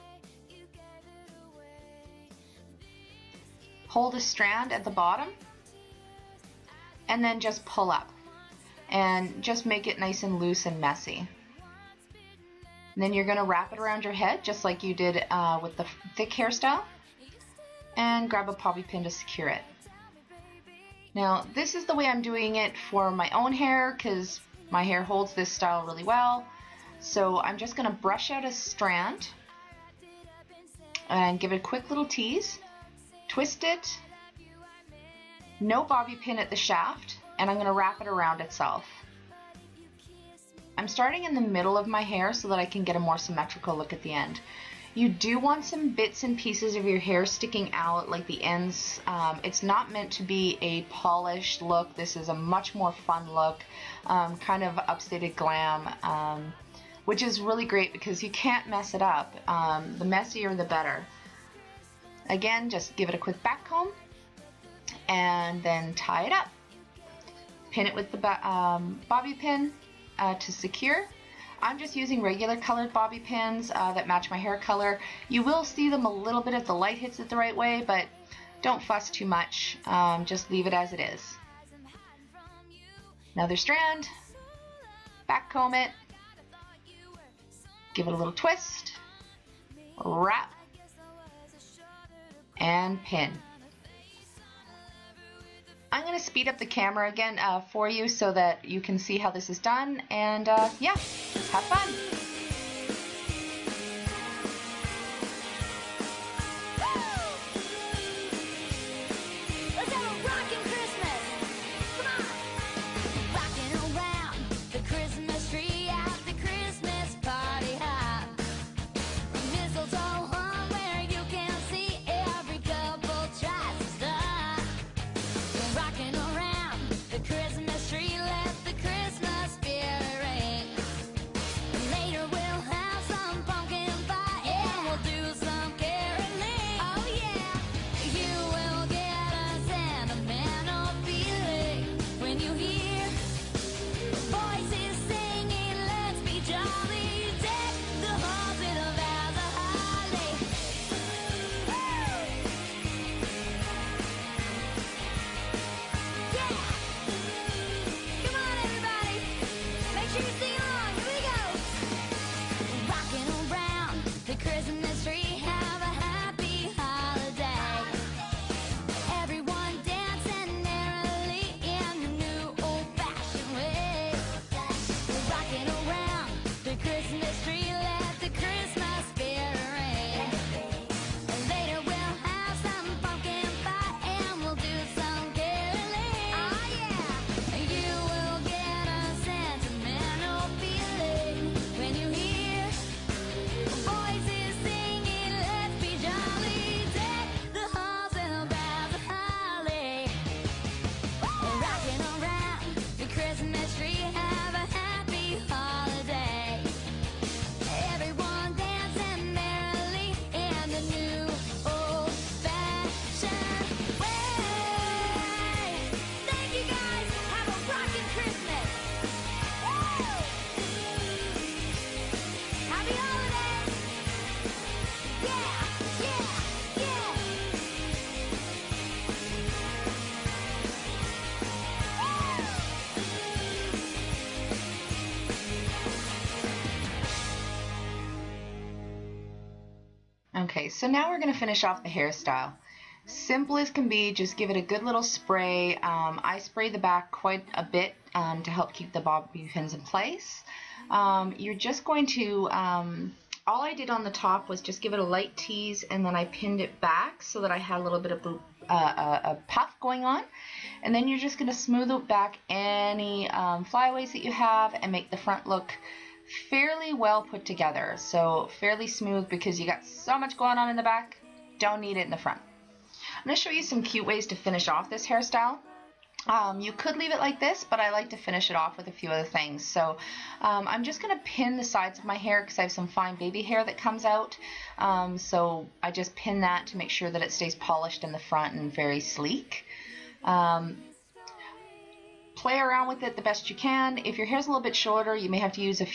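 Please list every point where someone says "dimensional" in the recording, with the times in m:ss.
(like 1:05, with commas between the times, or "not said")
not said.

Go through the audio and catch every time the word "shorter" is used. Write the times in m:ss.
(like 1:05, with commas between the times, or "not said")
4:54.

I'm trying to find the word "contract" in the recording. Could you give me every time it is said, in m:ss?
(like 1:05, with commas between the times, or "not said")
not said.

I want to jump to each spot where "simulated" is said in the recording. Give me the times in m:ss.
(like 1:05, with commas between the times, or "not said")
not said.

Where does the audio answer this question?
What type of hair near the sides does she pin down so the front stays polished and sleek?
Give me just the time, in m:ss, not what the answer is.
4:42.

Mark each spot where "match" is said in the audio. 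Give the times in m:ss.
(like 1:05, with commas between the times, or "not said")
1:14.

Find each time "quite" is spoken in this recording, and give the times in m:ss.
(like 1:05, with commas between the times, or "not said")
4:07.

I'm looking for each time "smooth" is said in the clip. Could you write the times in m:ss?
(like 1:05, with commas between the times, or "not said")
4:21, 4:28.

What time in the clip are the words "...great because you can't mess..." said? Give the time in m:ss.
0:57.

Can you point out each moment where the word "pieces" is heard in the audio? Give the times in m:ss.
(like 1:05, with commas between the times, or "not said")
0:46.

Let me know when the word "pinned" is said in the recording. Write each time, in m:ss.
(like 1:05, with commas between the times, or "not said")
4:16.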